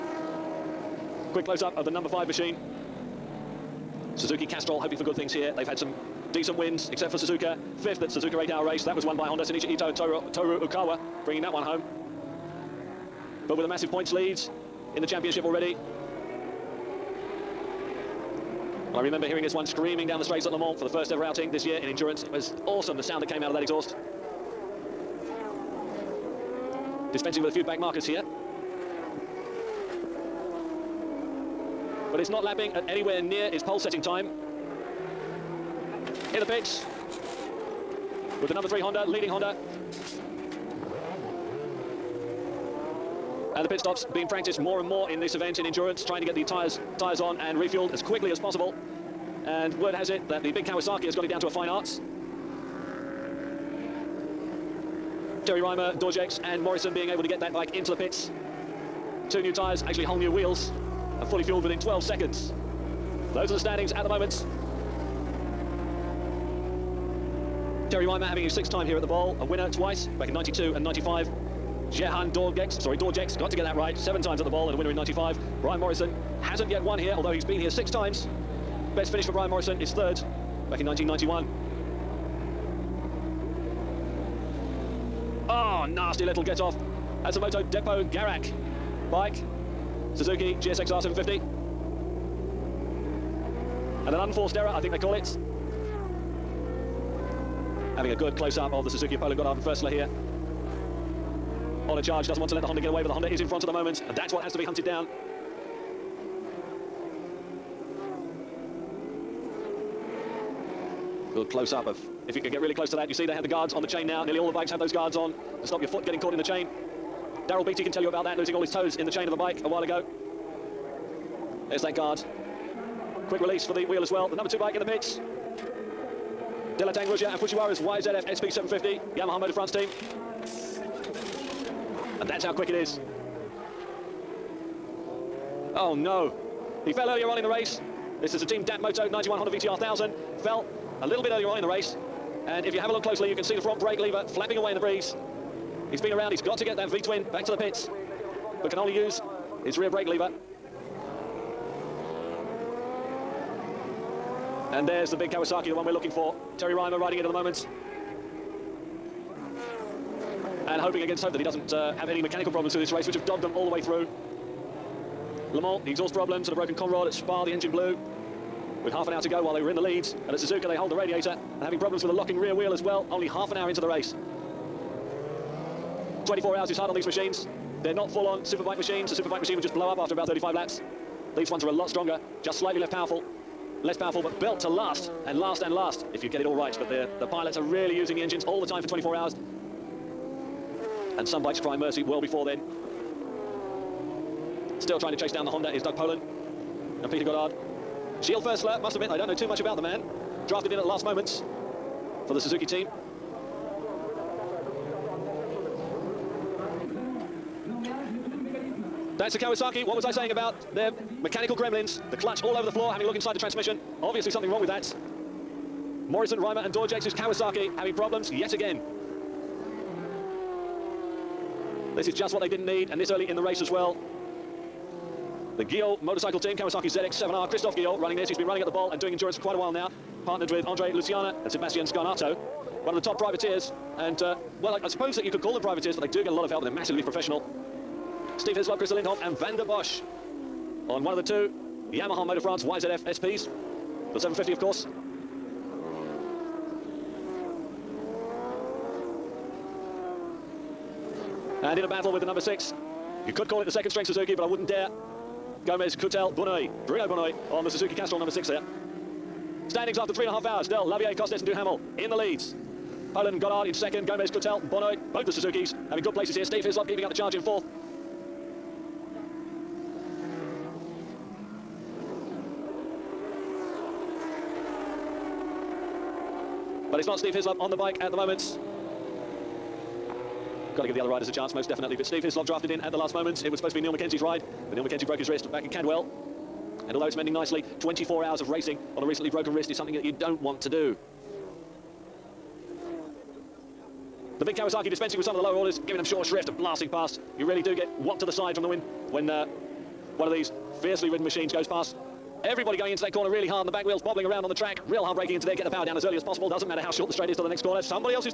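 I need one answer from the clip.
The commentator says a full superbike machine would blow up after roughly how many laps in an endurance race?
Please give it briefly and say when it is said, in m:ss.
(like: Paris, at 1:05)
35, at 3:00.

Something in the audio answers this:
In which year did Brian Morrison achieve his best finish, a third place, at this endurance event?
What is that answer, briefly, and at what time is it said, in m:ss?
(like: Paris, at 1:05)
1991, at 1:20.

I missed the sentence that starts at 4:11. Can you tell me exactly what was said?
And in a battle with the number six, you could call it the second string Suzuki, but I wouldn't dare.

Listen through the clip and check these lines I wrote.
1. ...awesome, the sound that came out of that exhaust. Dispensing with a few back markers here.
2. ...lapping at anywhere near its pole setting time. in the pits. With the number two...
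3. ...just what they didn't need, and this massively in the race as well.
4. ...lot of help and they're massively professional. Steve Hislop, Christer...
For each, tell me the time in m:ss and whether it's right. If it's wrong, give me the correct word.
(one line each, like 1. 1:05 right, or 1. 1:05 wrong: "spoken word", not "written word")
1. 0:22 right
2. 0:32 wrong: "three", not "two"
3. 3:42 wrong: "early", not "massively"
4. 3:56 right.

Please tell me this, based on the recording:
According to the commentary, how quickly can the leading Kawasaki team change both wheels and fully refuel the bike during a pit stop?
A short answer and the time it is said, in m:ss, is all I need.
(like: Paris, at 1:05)
12 seconds, at 1:01.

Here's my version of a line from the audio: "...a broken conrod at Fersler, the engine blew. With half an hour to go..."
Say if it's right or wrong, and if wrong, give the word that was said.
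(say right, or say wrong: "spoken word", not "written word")
wrong: "Spa", not "Fersler".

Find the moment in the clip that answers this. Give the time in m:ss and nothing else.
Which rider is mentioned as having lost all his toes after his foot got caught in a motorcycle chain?
1:57.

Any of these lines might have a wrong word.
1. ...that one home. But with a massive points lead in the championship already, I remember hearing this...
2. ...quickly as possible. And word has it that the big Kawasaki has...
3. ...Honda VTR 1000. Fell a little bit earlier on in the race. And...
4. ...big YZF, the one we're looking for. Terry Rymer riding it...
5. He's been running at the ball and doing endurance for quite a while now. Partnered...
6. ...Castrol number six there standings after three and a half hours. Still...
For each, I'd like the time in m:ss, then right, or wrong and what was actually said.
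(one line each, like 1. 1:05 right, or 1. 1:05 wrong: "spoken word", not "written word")
1. 0:11 right
2. 0:48 right
3. 2:19 right
4. 2:35 wrong: "Kawasaki", not "YZF"
5. 3:48 right
6. 4:17 right.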